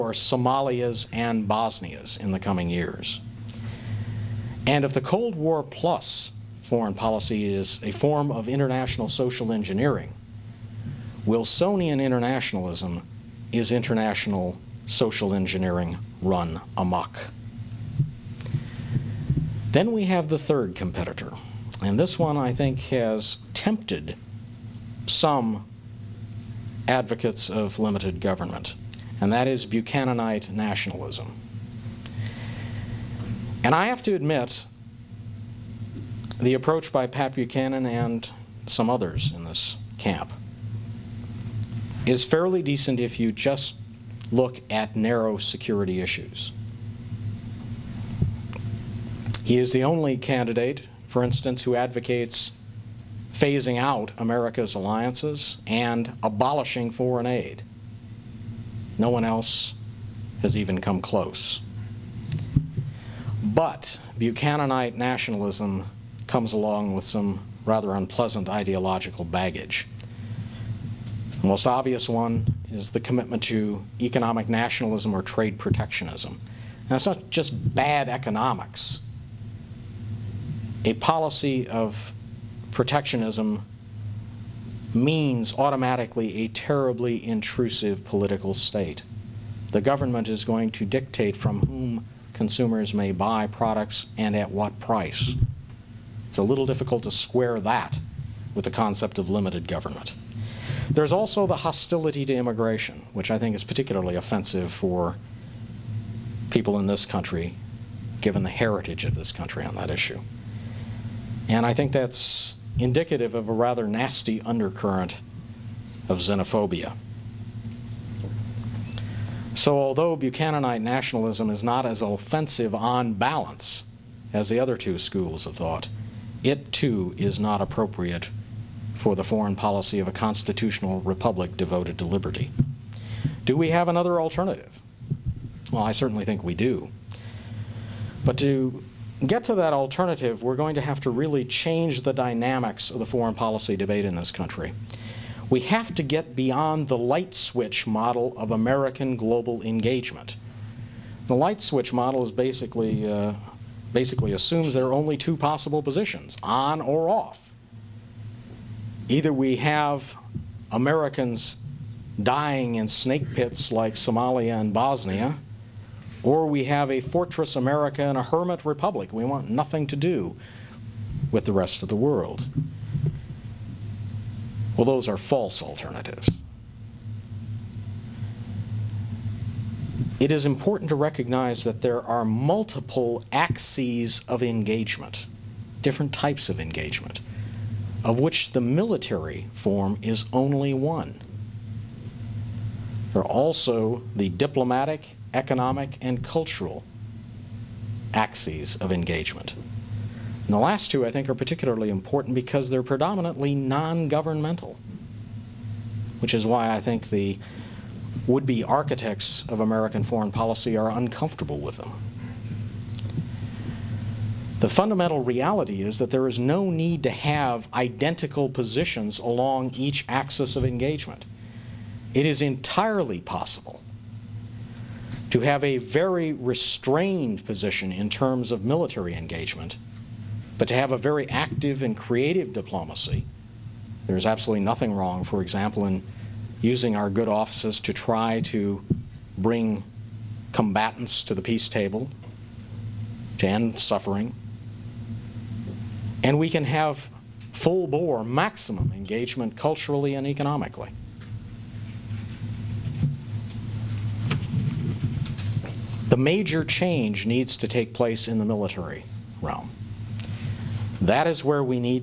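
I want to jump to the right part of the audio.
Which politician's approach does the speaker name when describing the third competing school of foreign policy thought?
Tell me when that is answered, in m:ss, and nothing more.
0:37.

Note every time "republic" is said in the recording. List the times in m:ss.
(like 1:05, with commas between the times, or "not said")
2:11, 2:48.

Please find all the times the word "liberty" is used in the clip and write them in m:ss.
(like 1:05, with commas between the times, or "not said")
2:12.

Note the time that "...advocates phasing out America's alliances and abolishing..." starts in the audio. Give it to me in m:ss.
0:51.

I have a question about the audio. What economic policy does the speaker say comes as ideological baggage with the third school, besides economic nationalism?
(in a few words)
Trade protectionism.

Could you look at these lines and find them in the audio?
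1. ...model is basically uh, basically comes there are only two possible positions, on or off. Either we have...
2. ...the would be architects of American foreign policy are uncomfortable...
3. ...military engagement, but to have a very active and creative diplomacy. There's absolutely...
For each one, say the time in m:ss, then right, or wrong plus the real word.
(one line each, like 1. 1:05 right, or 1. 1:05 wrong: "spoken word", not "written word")
1. 2:31 wrong: "assumes", not "comes"
2. 3:27 right
3. 3:48 right.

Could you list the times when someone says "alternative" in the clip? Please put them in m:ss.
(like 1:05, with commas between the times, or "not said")
2:14, 2:19, 2:55.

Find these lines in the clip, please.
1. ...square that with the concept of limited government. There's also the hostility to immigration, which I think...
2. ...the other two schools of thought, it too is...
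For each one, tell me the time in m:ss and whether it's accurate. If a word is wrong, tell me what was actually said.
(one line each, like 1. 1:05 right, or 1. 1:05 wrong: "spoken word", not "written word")
1. 1:37 right
2. 2:04 right.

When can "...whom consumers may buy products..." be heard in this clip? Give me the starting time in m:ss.
1:31.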